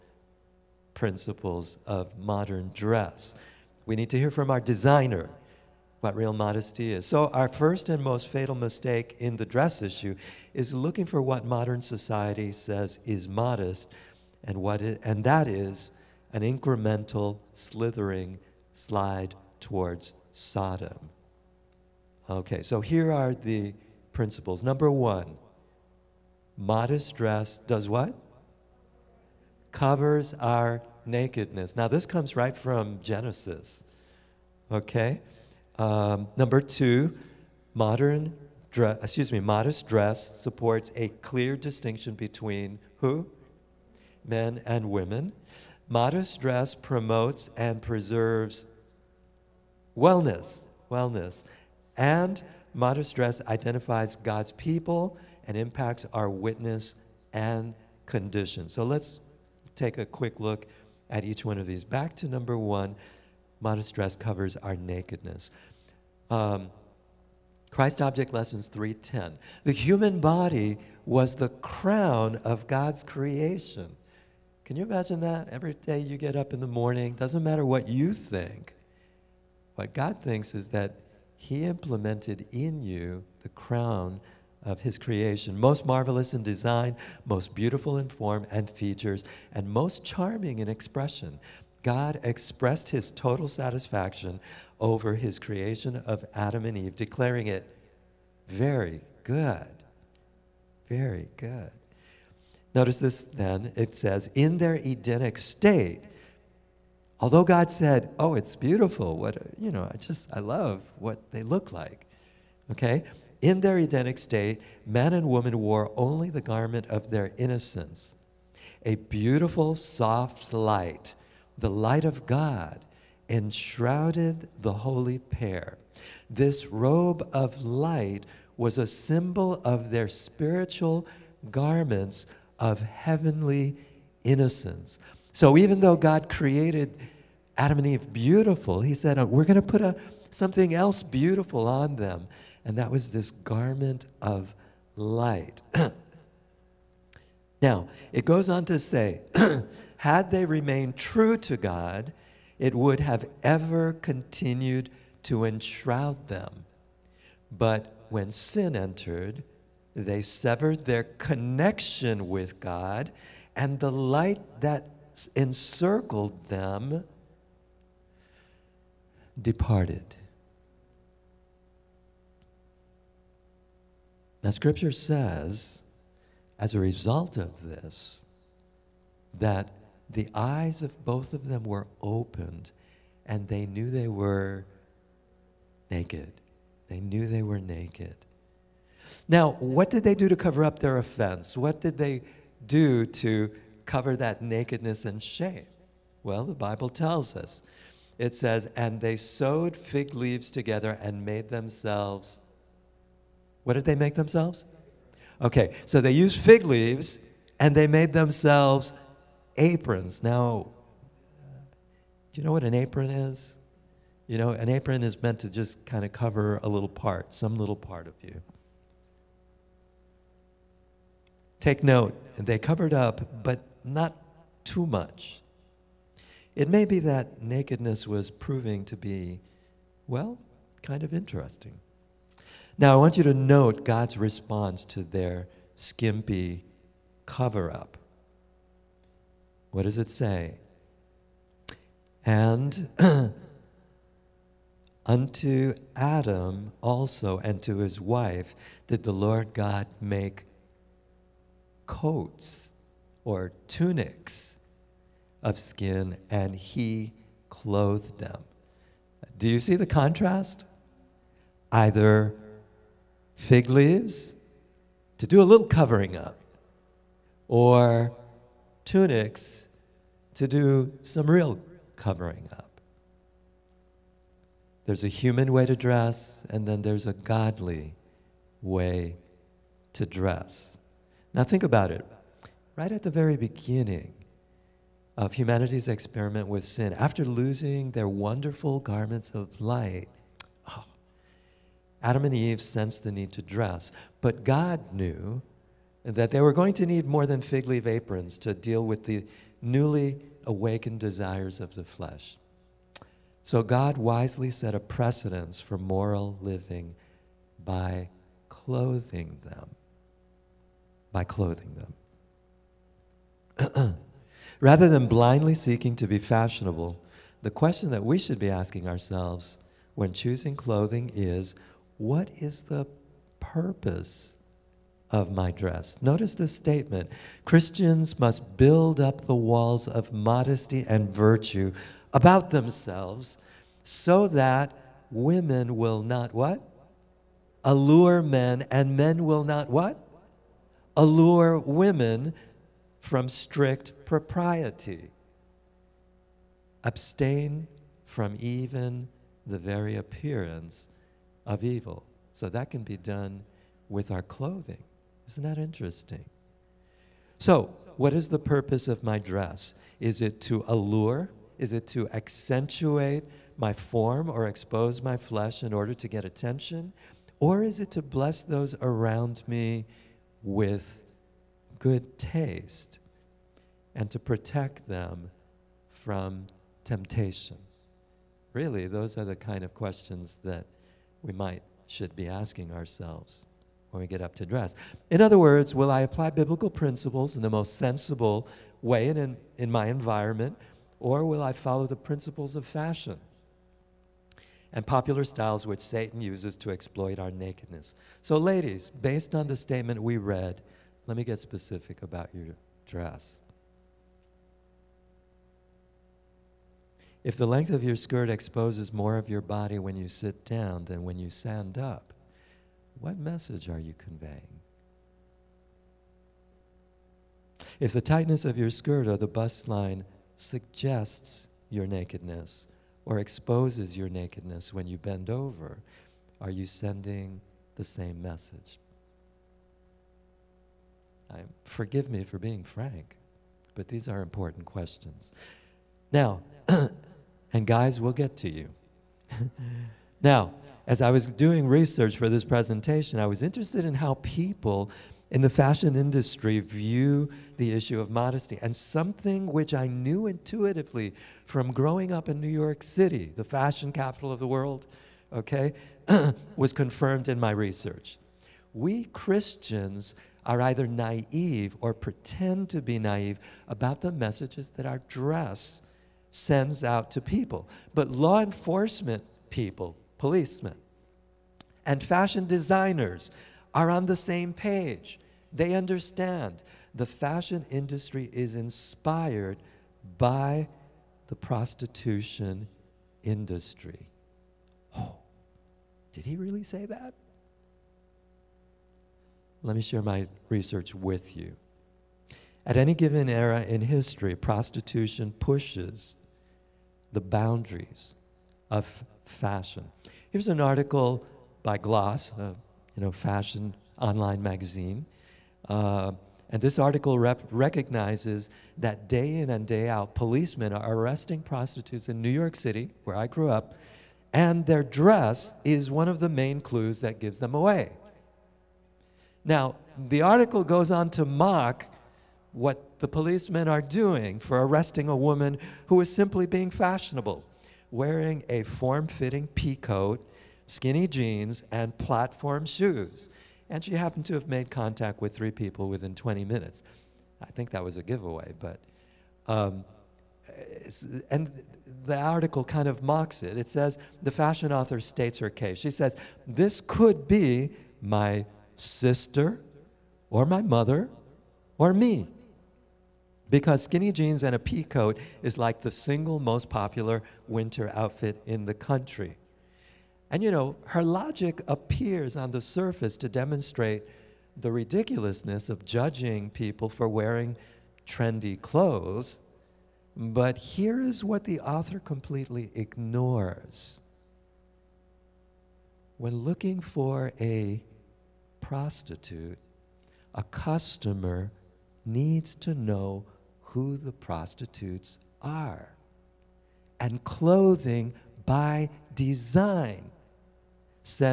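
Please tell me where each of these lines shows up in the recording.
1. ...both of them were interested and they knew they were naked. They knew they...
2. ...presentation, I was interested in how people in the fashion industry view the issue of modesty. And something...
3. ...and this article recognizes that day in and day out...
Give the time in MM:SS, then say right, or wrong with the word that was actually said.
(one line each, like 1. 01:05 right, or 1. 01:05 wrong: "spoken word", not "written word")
1. 03:01 wrong: "opened", not "interested"
2. 07:22 right
3. 08:26 right.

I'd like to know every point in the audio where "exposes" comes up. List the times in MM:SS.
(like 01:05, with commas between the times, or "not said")
06:04, 06:48, 07:03.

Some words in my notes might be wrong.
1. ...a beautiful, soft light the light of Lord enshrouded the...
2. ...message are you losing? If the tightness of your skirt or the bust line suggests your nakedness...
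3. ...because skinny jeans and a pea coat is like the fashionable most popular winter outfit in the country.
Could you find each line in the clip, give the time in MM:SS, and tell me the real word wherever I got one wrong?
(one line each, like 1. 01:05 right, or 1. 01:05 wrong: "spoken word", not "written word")
1. 01:58 wrong: "God", not "Lord"
2. 06:53 wrong: "conveying", not "losing"
3. 09:13 wrong: "single", not "fashionable".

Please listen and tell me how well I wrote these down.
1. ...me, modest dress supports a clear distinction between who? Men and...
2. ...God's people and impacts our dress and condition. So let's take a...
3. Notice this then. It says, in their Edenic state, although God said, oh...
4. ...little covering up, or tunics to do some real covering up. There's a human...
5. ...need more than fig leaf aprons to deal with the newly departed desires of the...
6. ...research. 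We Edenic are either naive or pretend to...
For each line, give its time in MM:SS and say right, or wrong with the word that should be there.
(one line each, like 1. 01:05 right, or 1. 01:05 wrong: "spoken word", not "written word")
1. 00:39 right
2. 00:54 wrong: "witness", not "dress"
3. 01:42 right
4. 04:25 right
5. 04:56 wrong: "awakened", not "departed"
6. 07:37 wrong: "Christians", not "Edenic".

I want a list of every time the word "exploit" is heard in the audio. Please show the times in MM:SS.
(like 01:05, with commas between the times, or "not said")
06:36.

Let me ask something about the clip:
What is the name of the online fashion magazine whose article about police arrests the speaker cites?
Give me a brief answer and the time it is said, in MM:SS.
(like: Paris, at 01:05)
Gloss, at 08:21.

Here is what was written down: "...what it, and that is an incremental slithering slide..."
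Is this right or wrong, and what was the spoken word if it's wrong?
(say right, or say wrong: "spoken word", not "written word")
right.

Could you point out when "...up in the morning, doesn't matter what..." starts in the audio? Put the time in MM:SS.
01:16.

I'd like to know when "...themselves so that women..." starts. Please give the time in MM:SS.
05:32.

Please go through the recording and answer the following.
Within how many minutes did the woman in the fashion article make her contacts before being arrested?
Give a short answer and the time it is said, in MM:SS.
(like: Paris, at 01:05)
20, at 08:56.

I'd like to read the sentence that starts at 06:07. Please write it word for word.
Or is it to bless those around me with good taste and to protect them from temptation?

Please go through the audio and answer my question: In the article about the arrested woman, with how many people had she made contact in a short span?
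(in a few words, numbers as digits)
3.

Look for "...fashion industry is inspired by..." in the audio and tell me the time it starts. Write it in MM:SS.
07:57.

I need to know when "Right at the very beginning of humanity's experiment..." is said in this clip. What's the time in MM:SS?
04:42.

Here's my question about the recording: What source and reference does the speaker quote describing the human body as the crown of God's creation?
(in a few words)
Christ Object Lessons 3:10.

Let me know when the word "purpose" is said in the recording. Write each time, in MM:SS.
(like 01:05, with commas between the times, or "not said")
05:23, 05:58.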